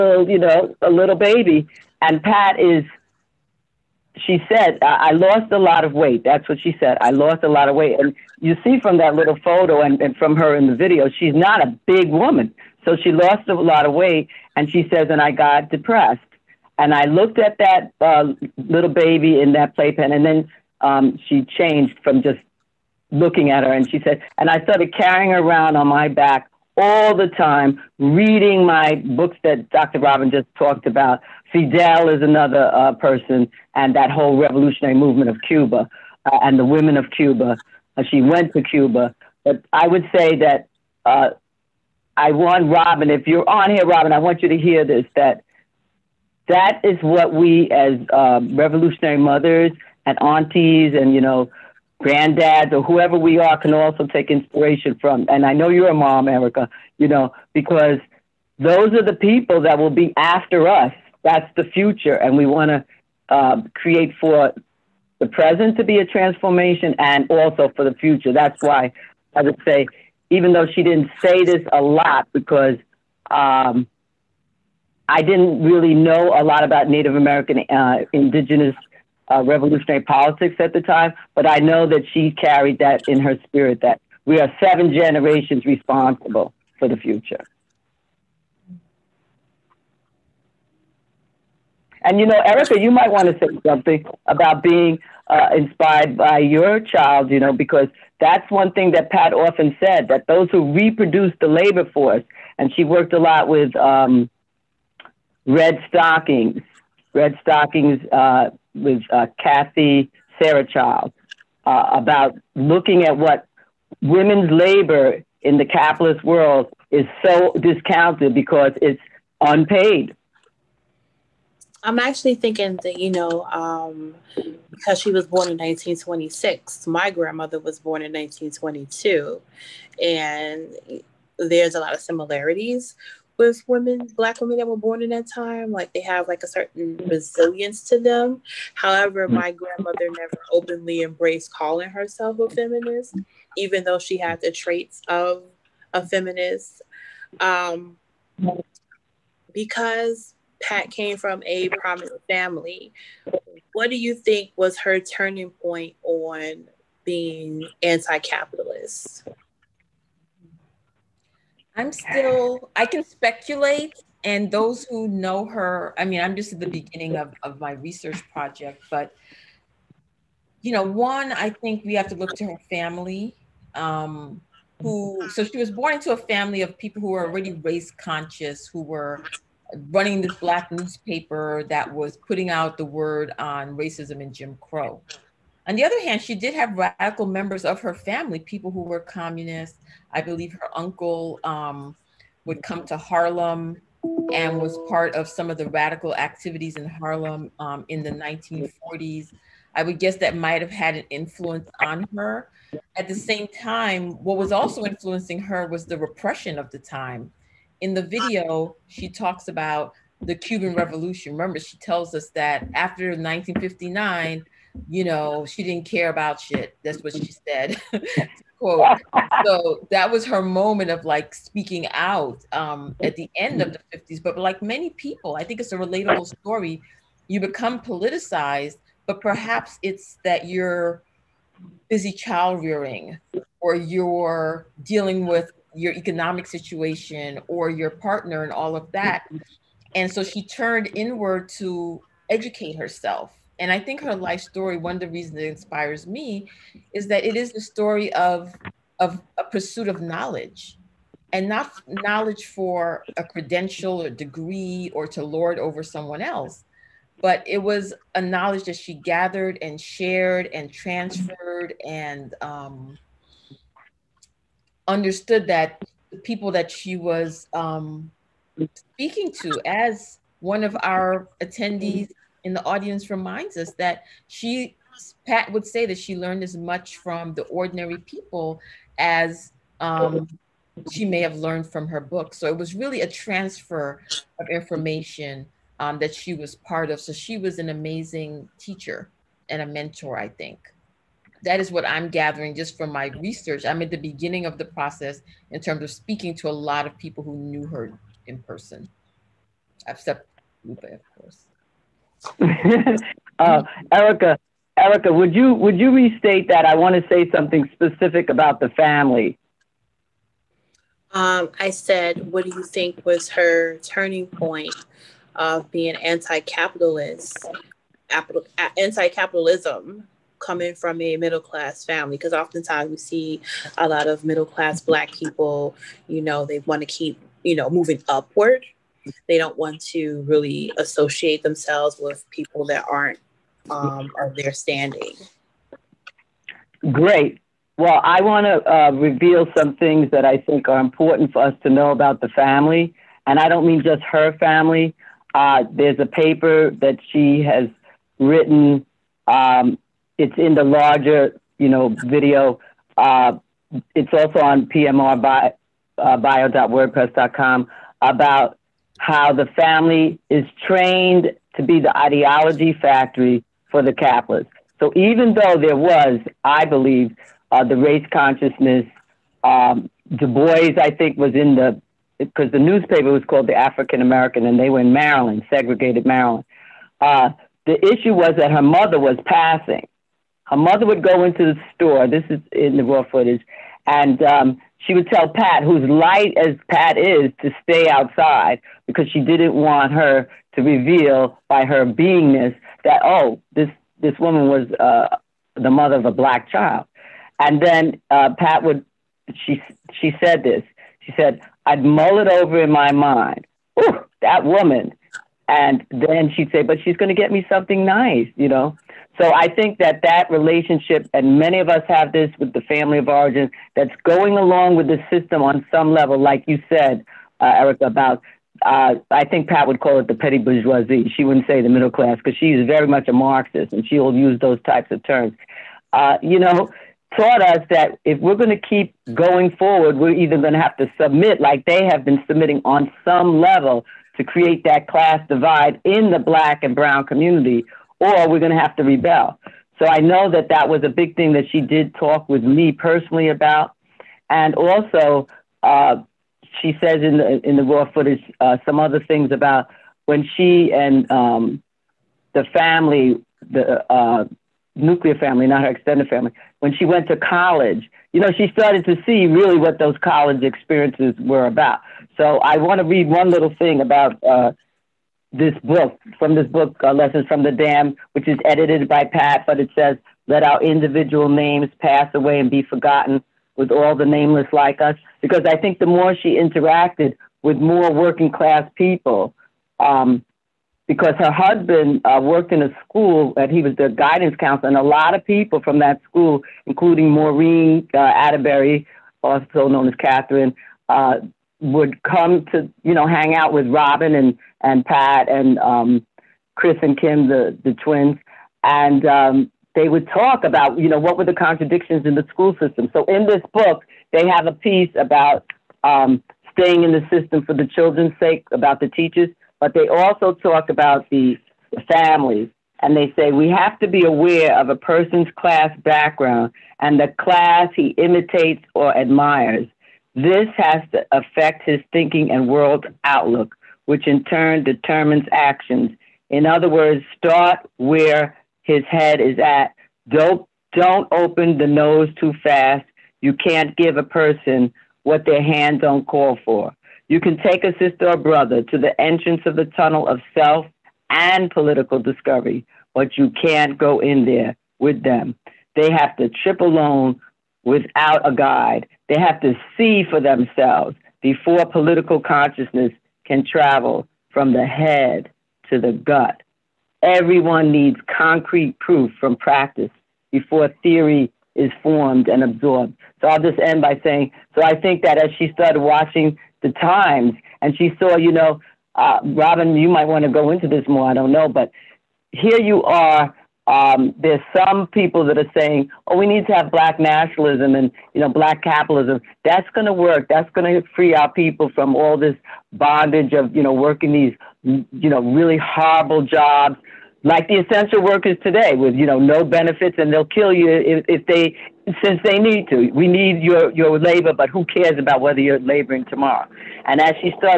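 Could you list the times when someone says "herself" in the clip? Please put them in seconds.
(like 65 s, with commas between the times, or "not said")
141 s, 242 s.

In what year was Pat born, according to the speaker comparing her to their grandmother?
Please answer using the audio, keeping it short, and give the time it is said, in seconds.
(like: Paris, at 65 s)
1926, at 125 s.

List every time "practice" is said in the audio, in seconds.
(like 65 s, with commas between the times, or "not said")
559 s.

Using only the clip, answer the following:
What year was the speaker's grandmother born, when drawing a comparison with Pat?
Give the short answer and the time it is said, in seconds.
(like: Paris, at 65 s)
1922, at 128 s.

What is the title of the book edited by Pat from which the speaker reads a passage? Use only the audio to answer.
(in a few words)
Lessons from the Damned.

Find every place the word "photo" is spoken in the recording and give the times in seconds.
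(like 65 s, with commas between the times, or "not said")
9 s.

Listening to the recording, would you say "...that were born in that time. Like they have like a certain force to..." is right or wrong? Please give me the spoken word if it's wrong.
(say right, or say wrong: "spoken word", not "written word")
wrong: "resilience", not "force".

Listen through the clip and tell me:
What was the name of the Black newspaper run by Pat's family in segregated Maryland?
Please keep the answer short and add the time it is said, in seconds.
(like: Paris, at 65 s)
the African American, at 373 s.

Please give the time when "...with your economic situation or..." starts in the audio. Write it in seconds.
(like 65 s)
235 s.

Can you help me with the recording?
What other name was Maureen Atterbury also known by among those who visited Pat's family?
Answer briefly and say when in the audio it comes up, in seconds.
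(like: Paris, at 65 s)
Catherine, at 489 s.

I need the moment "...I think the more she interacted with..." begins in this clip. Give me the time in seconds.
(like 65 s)
475 s.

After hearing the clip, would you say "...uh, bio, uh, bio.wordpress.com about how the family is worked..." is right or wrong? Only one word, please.
wrong.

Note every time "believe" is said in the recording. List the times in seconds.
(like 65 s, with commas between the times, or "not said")
190 s, 366 s.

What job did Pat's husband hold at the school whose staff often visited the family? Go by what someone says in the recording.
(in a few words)
guidance counselor.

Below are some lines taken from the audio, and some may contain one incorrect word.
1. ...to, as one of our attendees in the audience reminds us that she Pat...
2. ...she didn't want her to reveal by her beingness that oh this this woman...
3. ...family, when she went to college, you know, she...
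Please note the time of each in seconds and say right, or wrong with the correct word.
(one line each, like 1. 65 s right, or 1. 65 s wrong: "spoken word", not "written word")
1. 269 s right
2. 389 s right
3. 456 s right.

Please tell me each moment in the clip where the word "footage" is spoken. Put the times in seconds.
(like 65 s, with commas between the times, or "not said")
383 s, 447 s.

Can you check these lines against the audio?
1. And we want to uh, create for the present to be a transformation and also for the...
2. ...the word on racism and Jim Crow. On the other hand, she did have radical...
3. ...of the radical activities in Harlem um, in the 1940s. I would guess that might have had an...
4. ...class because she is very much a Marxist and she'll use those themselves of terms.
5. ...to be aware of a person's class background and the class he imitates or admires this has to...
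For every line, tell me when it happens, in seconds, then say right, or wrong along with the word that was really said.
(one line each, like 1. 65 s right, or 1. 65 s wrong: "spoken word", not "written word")
1. 62 s right
2. 182 s right
3. 195 s right
4. 421 s wrong: "types", not "themselves"
5. 513 s right.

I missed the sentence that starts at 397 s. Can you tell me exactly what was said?
And then uh, Pat would she she said this.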